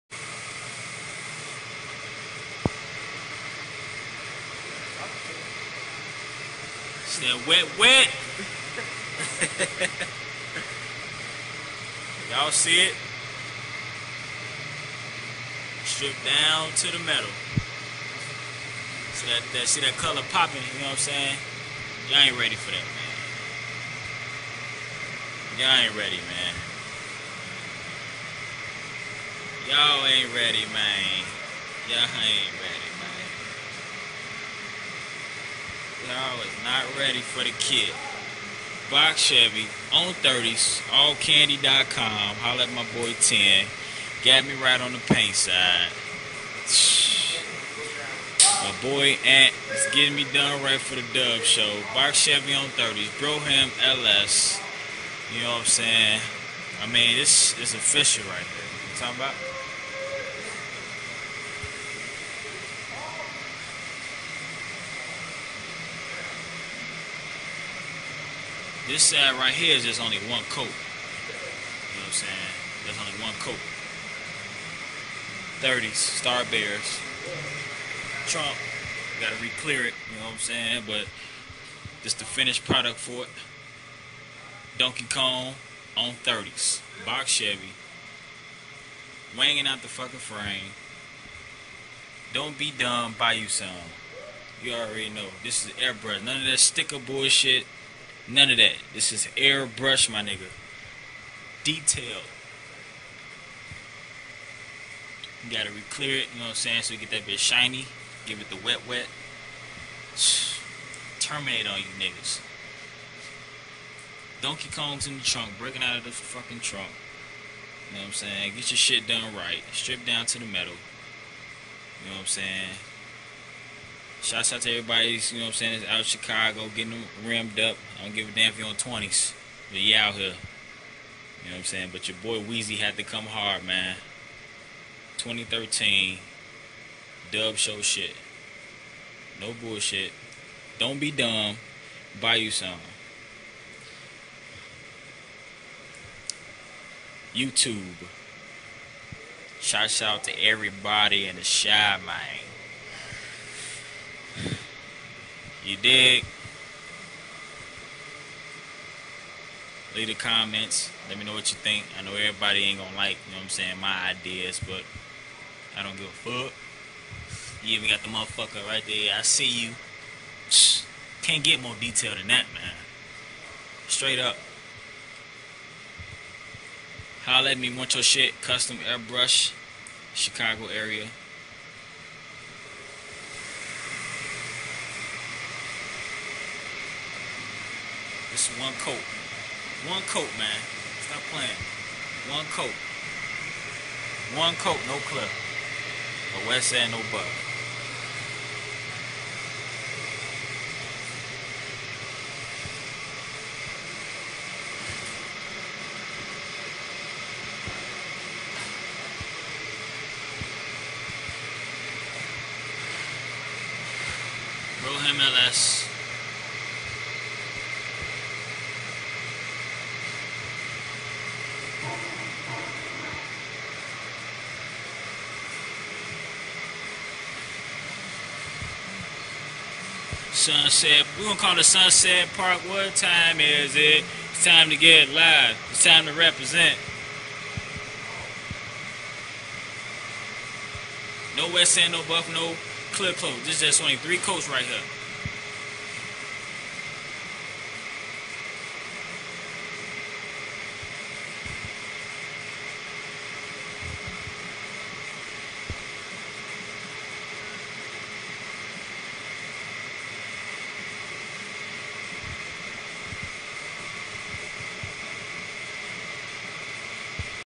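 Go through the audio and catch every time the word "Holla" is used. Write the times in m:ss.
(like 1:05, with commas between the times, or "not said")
0:42, 2:57.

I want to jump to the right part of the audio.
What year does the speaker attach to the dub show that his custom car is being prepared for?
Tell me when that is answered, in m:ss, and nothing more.
2:15.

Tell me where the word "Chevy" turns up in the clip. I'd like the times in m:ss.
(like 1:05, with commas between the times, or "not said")
0:39, 0:52, 1:27.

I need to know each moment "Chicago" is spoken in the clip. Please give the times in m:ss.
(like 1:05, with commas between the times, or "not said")
2:06, 3:00.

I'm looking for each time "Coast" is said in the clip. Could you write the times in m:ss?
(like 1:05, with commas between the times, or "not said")
4:03.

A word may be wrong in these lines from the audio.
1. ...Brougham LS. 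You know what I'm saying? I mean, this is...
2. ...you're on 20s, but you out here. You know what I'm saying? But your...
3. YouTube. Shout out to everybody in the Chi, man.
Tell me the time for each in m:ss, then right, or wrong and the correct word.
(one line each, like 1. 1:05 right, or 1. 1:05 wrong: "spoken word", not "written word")
1. 0:53 right
2. 2:08 right
3. 2:27 right.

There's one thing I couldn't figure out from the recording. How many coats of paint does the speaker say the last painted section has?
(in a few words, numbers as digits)
3.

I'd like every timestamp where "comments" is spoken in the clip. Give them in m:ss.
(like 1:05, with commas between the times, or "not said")
2:40.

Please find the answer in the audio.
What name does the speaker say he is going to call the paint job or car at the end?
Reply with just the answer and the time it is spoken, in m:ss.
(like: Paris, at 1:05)
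Sunset Park, at 3:51.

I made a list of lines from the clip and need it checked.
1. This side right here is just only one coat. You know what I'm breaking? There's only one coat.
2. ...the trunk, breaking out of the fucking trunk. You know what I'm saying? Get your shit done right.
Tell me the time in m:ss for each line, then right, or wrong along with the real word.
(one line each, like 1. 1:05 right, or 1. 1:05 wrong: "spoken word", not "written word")
1. 1:08 wrong: "saying", not "breaking"
2. 1:55 right.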